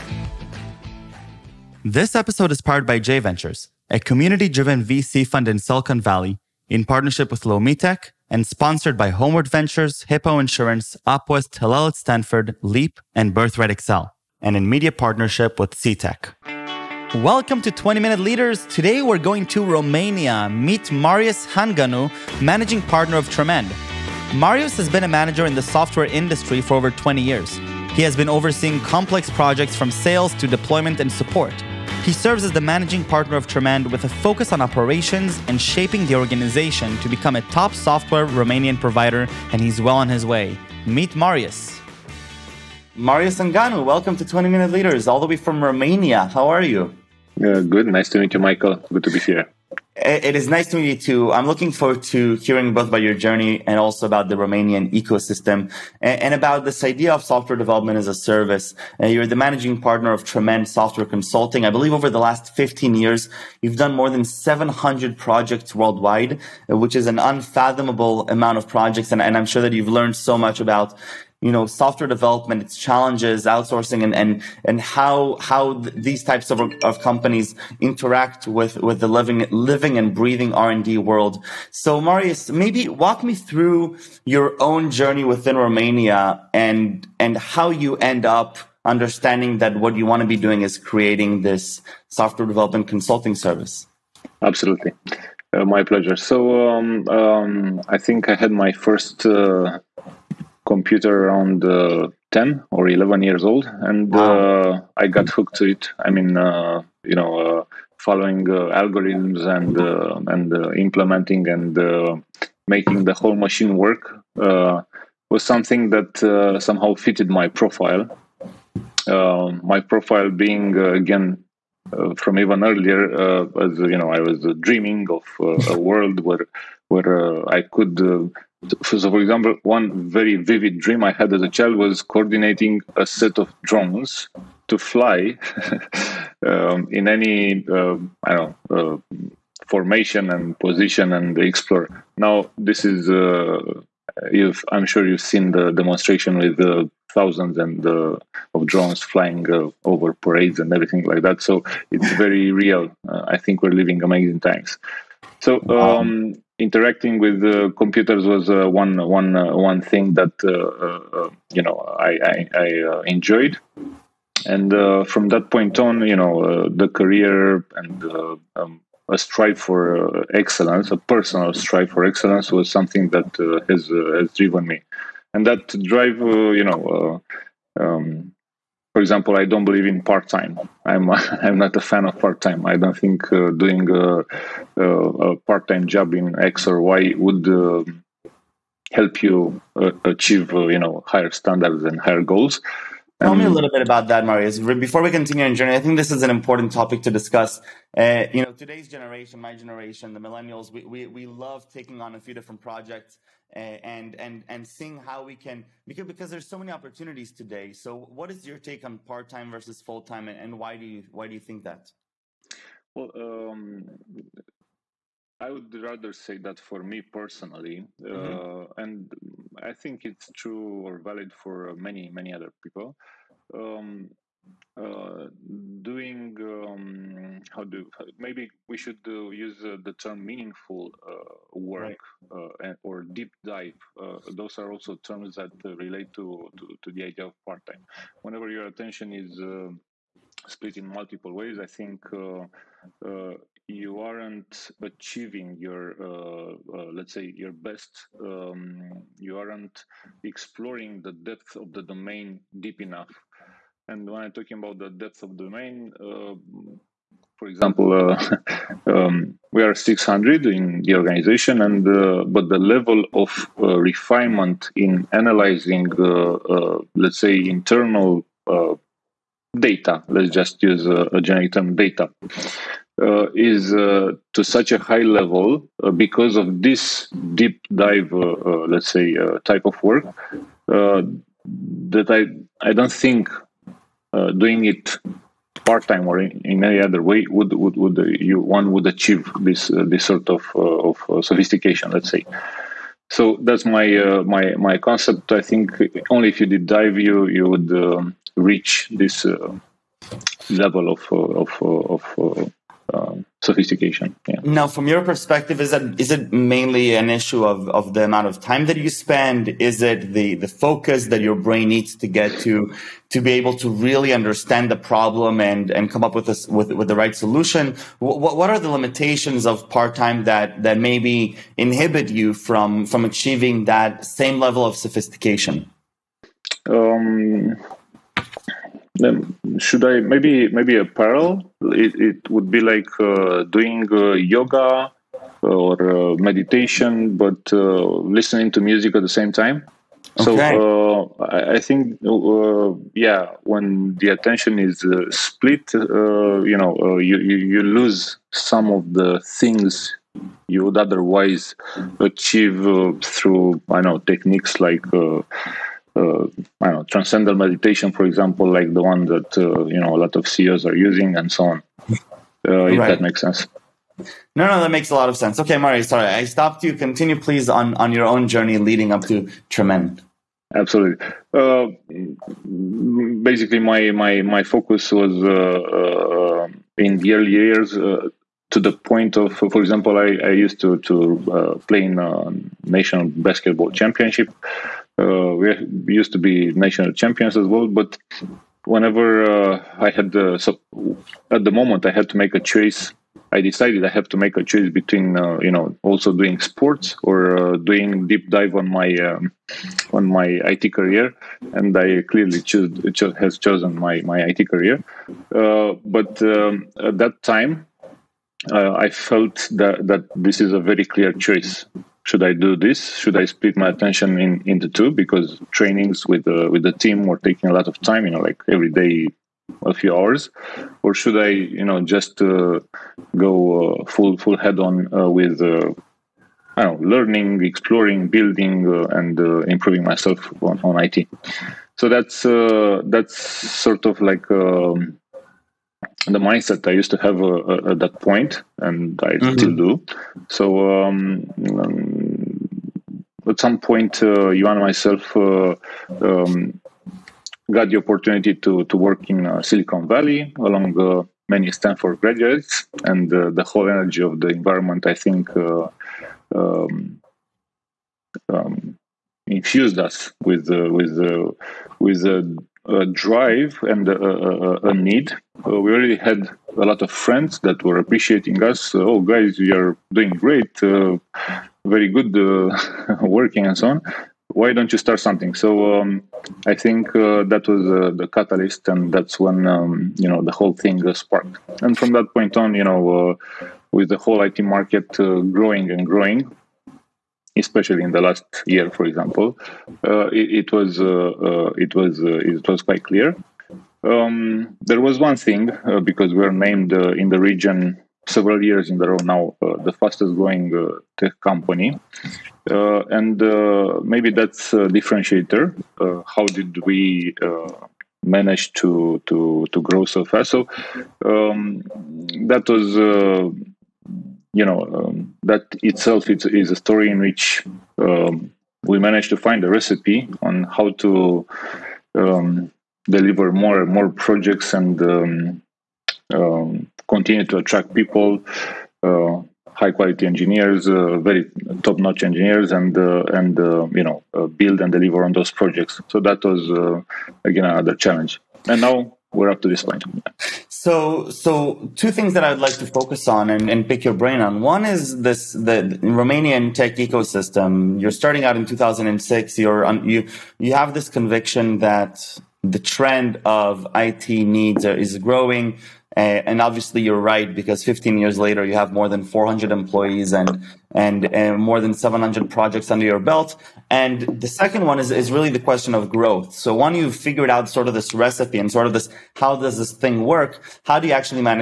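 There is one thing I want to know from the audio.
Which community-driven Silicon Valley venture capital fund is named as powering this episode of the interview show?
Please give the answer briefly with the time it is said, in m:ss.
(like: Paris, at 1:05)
J Ventures, at 0:02.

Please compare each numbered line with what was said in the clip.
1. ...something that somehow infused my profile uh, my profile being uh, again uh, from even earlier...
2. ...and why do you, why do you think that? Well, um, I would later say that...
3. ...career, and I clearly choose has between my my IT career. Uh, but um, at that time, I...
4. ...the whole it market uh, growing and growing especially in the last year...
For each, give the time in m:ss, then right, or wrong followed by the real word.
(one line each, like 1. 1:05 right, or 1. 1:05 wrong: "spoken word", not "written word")
1. 1:55 wrong: "fitted", not "infused"
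2. 3:30 wrong: "rather", not "later"
3. 6:40 wrong: "chosen", not "between"
4. 8:03 right.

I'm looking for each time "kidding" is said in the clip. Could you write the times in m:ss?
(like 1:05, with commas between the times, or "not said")
not said.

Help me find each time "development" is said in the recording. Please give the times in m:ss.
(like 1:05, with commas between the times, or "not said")
0:57, 1:12, 1:32.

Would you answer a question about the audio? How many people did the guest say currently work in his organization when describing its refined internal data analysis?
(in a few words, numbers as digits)
600.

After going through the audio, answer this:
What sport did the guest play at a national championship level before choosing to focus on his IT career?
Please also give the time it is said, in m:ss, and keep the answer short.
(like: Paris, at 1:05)
basketball, at 6:23.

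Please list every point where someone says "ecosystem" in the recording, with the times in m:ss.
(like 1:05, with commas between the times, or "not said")
0:54, 9:06.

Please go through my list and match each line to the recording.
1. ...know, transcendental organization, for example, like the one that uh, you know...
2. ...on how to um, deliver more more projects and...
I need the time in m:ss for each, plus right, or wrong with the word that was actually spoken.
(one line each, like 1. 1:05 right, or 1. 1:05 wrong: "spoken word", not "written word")
1. 5:56 wrong: "meditation", not "organization"
2. 8:40 right.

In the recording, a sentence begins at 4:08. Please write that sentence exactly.
Um, you aren't exploring the depth of the domain deep enough.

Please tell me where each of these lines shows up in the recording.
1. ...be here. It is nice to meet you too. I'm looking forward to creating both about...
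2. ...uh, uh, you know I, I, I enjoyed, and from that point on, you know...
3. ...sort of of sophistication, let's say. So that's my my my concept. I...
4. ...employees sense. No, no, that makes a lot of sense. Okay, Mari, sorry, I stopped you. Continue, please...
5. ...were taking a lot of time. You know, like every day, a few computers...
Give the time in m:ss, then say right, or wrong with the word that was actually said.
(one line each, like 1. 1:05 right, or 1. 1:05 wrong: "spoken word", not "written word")
1. 0:49 wrong: "hearing", not "creating"
2. 2:40 right
3. 4:50 right
4. 6:03 wrong: "makes", not "employees"
5. 6:57 wrong: "hours", not "computers".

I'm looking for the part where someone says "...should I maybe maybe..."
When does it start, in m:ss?
5:29.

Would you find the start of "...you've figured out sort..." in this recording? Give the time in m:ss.
9:26.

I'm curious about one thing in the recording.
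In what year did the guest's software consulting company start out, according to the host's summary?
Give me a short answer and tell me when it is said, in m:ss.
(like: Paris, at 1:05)
2006, at 9:08.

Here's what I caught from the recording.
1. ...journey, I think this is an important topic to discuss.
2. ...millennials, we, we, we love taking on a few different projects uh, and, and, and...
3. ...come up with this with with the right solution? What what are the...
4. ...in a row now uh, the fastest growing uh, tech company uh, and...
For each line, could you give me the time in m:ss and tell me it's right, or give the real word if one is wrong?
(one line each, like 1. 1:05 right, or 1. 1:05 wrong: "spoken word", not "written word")
1. 3:15 right
2. 3:20 right
3. 5:15 right
4. 8:18 right.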